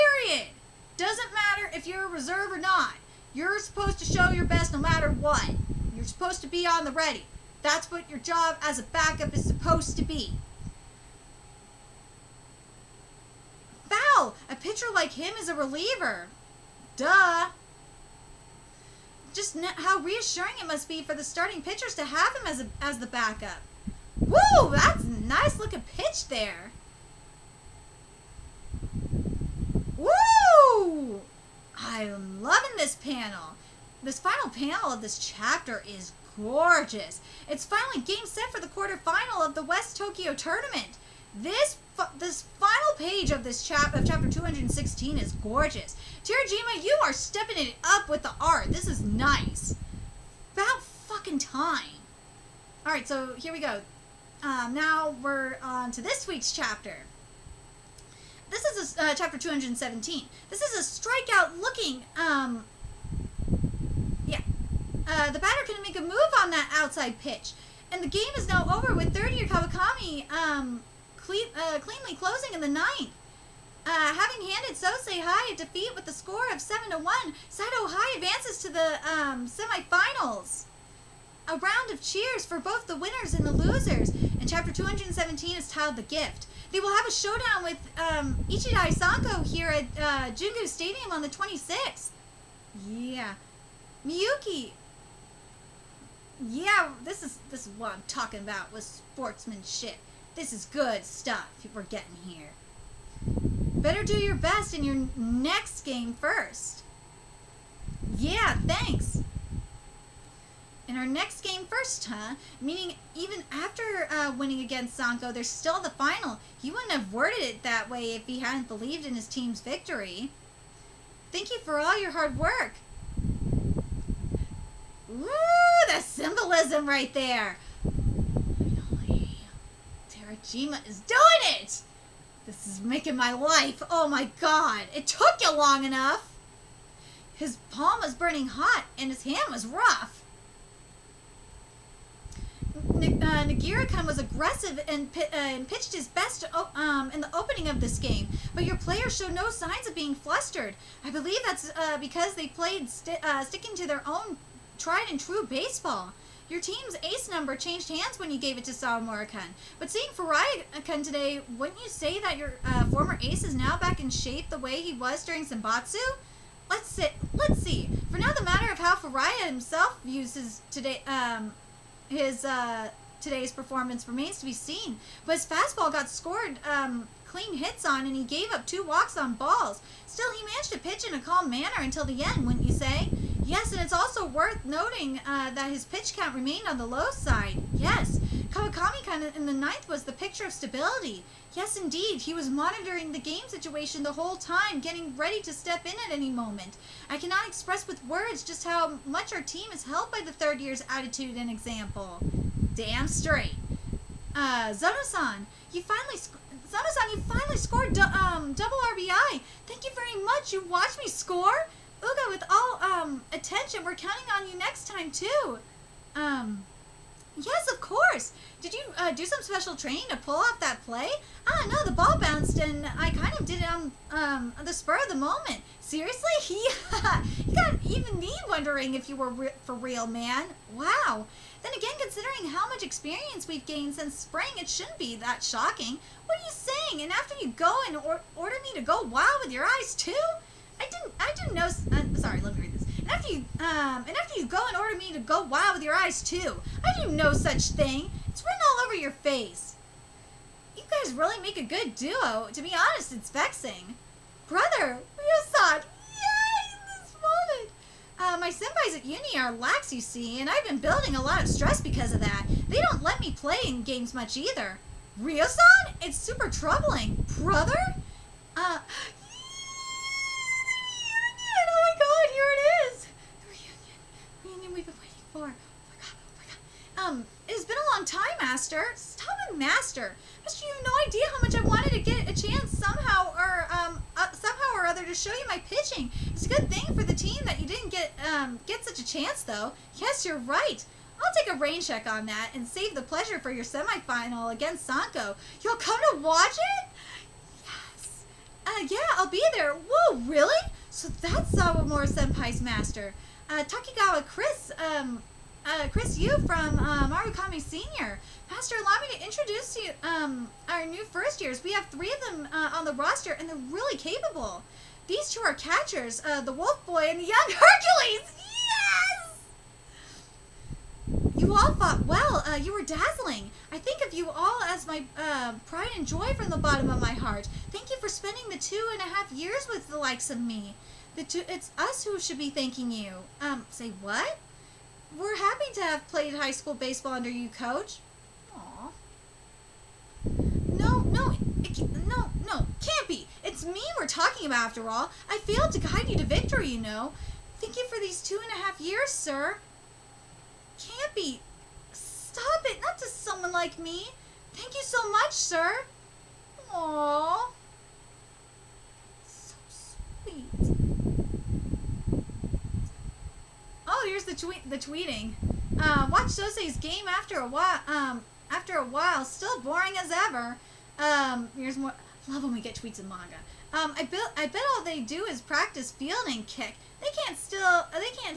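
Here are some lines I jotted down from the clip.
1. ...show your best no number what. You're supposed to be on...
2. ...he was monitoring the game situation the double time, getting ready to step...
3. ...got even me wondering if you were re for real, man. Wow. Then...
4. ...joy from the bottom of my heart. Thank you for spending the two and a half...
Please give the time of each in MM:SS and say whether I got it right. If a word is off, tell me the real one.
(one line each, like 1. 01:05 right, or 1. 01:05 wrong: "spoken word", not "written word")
1. 00:04 wrong: "matter", not "number"
2. 03:12 wrong: "whole", not "double"
3. 03:47 right
4. 05:26 right.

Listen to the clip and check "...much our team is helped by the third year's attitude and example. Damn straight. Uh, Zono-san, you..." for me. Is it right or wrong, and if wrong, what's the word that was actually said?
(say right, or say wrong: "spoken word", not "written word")
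right.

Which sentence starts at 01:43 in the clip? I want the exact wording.
Better do your best in your next game first.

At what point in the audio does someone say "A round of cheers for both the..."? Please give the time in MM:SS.
01:21.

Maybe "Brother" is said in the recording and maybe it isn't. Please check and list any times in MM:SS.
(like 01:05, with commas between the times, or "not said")
04:14, 04:27.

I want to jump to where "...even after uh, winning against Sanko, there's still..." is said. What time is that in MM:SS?
01:53.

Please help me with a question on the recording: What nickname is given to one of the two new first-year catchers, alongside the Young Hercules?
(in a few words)
Wolf Boy.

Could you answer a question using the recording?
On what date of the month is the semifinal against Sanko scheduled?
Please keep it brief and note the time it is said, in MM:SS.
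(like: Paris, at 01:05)
26th, at 01:31.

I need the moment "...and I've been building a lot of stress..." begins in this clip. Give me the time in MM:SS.
04:20.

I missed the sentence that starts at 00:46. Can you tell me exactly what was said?
Terajima, you are stepping it up with the art.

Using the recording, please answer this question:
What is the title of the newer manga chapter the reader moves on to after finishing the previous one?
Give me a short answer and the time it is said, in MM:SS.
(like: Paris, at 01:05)
The Gift, at 01:25.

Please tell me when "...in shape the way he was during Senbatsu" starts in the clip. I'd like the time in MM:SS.
02:43.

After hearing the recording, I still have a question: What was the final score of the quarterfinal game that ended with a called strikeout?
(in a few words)
7 to 1.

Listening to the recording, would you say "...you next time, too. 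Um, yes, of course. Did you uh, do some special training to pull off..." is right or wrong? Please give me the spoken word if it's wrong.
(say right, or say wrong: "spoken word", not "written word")
right.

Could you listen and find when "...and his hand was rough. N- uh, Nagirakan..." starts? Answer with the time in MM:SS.
02:18.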